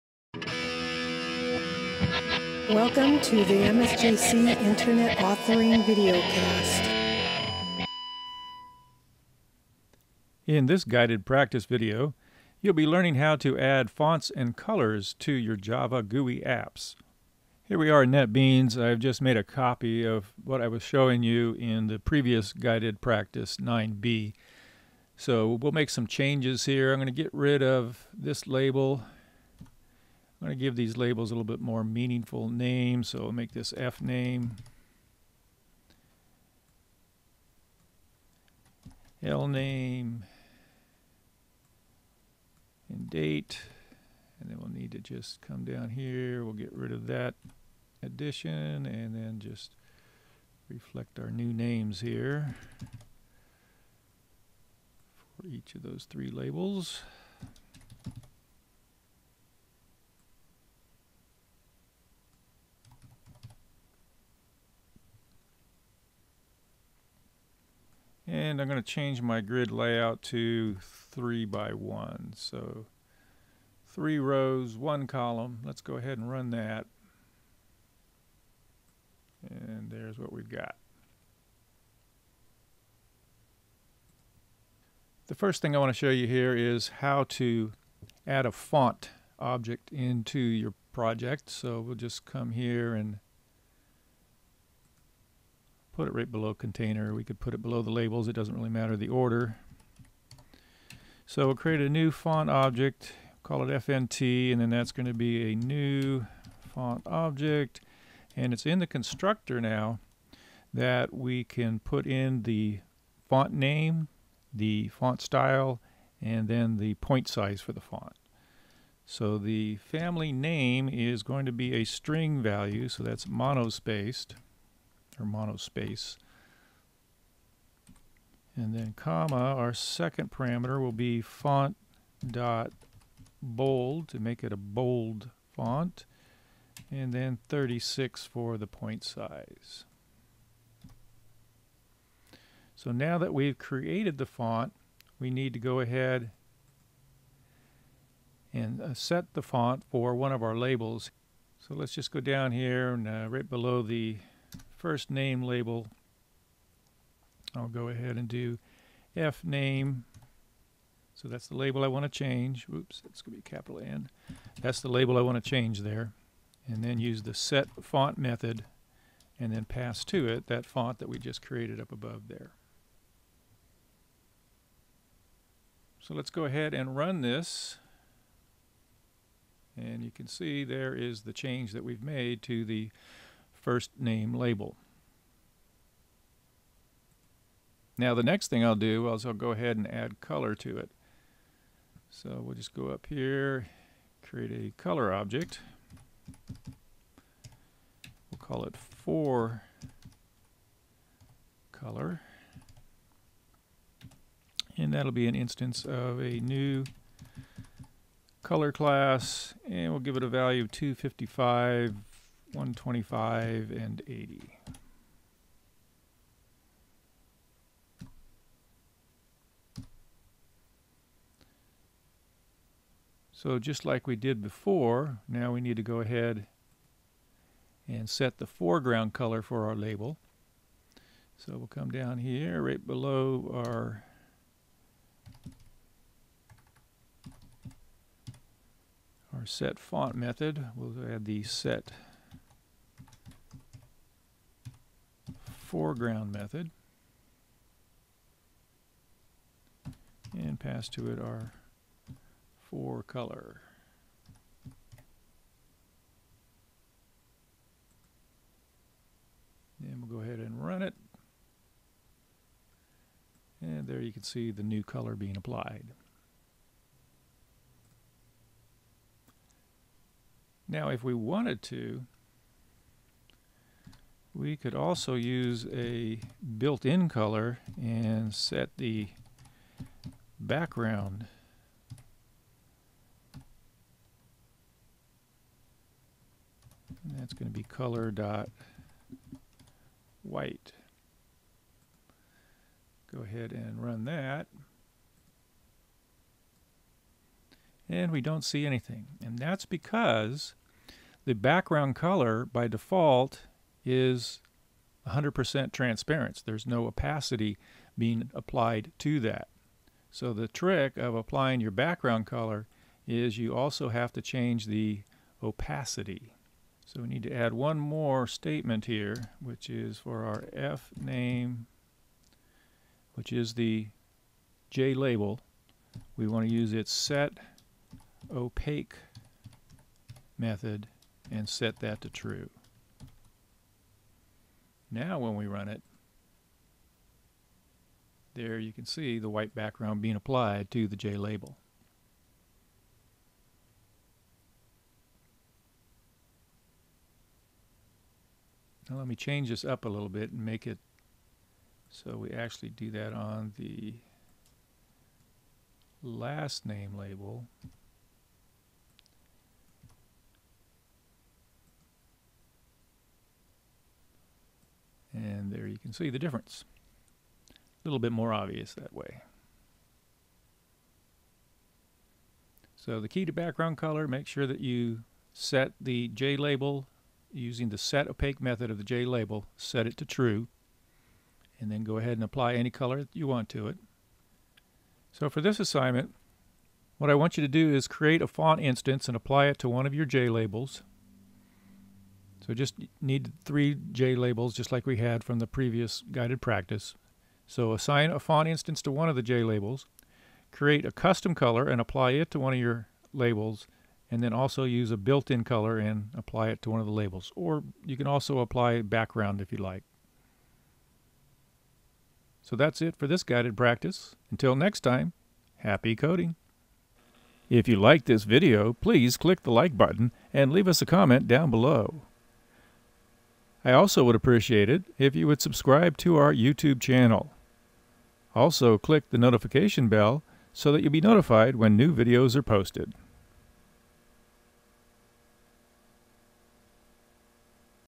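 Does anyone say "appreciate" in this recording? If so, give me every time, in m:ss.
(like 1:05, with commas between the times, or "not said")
7:04.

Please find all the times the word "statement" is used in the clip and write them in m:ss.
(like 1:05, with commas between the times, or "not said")
5:18.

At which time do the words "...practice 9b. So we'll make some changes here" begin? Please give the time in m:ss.
0:23.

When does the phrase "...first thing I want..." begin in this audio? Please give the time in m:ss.
1:25.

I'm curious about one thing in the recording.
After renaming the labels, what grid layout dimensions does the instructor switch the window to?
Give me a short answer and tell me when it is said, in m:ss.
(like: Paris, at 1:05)
3 by 1, at 1:10.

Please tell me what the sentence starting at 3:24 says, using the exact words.
And that'll be an instance of a new color class and we'll give it a value of 255 125 and 80.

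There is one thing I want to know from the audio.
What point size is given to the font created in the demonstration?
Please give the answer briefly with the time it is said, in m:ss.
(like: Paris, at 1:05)
36, at 2:17.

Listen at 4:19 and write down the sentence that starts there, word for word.
And we'll go ahead and run it.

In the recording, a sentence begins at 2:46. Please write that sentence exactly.
And then use the set font method and then pass to it that font that we just created up above there.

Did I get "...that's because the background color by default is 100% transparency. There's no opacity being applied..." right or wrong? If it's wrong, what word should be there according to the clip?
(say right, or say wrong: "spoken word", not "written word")
right.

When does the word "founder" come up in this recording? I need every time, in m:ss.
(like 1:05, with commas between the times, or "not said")
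not said.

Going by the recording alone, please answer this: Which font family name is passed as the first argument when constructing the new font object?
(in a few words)
monospaced.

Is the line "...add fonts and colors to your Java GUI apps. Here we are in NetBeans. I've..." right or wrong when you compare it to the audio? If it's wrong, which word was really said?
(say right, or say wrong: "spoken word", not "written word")
right.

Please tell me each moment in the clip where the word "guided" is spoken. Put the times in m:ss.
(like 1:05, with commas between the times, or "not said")
0:10, 0:22, 6:36, 6:53.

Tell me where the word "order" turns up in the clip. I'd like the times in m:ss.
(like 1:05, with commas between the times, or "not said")
1:39.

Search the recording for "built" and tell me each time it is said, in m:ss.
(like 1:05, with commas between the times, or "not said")
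4:36, 6:44.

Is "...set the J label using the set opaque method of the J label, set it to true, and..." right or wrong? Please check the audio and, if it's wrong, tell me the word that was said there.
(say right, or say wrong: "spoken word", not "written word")
right.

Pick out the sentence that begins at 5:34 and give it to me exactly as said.
Now when we run it, there you can see the white background being applied to the J label.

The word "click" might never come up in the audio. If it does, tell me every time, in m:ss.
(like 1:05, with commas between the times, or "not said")
6:59, 7:08.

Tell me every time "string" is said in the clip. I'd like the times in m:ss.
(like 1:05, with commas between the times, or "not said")
2:01.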